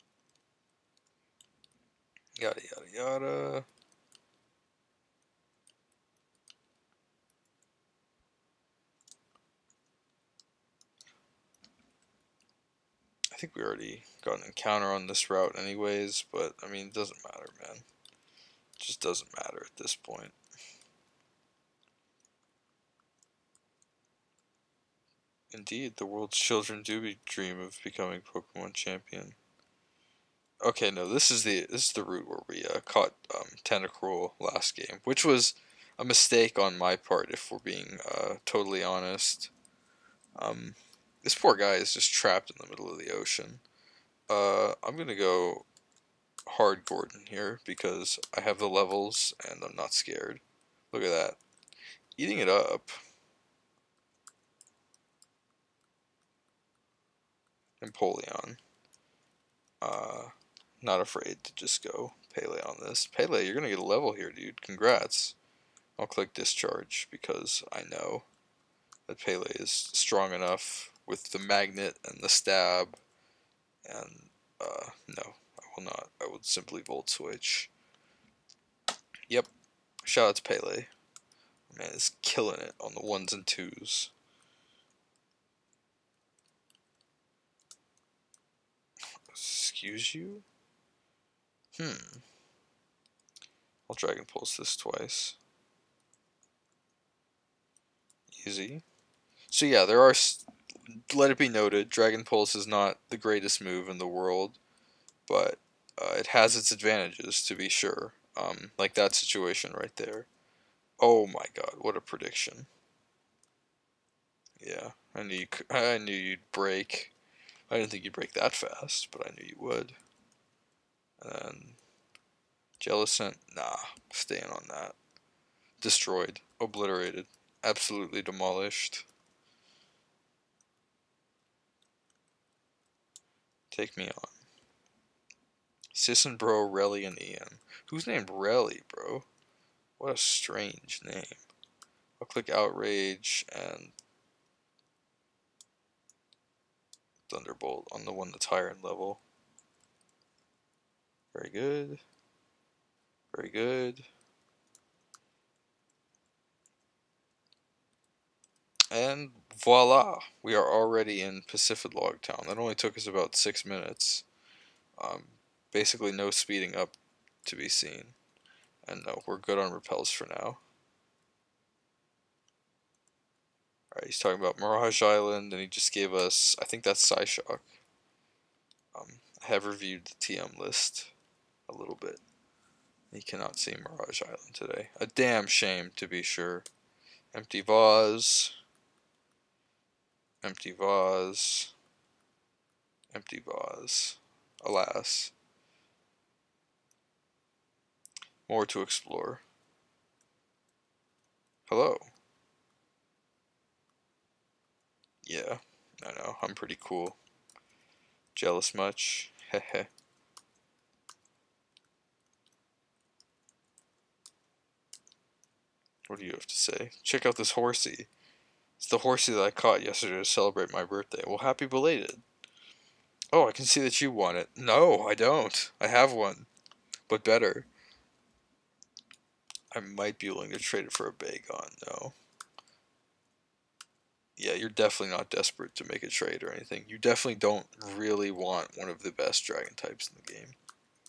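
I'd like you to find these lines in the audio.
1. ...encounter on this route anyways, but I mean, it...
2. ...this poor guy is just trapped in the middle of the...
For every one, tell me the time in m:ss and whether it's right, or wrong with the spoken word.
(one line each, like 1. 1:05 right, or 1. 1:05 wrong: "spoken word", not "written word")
1. 0:14 right
2. 0:41 right.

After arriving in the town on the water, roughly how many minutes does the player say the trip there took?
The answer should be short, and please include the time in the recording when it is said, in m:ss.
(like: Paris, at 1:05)
6 minutes, at 2:43.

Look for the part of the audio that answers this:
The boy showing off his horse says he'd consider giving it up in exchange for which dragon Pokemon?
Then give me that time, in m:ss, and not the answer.
3:51.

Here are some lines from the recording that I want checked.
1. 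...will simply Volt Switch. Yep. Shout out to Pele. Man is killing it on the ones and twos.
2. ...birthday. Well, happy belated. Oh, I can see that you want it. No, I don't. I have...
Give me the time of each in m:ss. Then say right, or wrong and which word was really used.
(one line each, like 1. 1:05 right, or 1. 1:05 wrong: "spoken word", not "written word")
1. 1:16 right
2. 3:40 right.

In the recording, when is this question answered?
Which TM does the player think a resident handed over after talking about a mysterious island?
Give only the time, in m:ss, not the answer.
2:57.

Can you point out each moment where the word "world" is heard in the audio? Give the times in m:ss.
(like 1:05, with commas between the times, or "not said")
0:26, 1:44.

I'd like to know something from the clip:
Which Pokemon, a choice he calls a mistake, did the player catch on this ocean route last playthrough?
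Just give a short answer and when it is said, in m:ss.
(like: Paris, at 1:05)
Tentacruel, at 0:33.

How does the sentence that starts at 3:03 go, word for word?
He cannot see Mirage Island today.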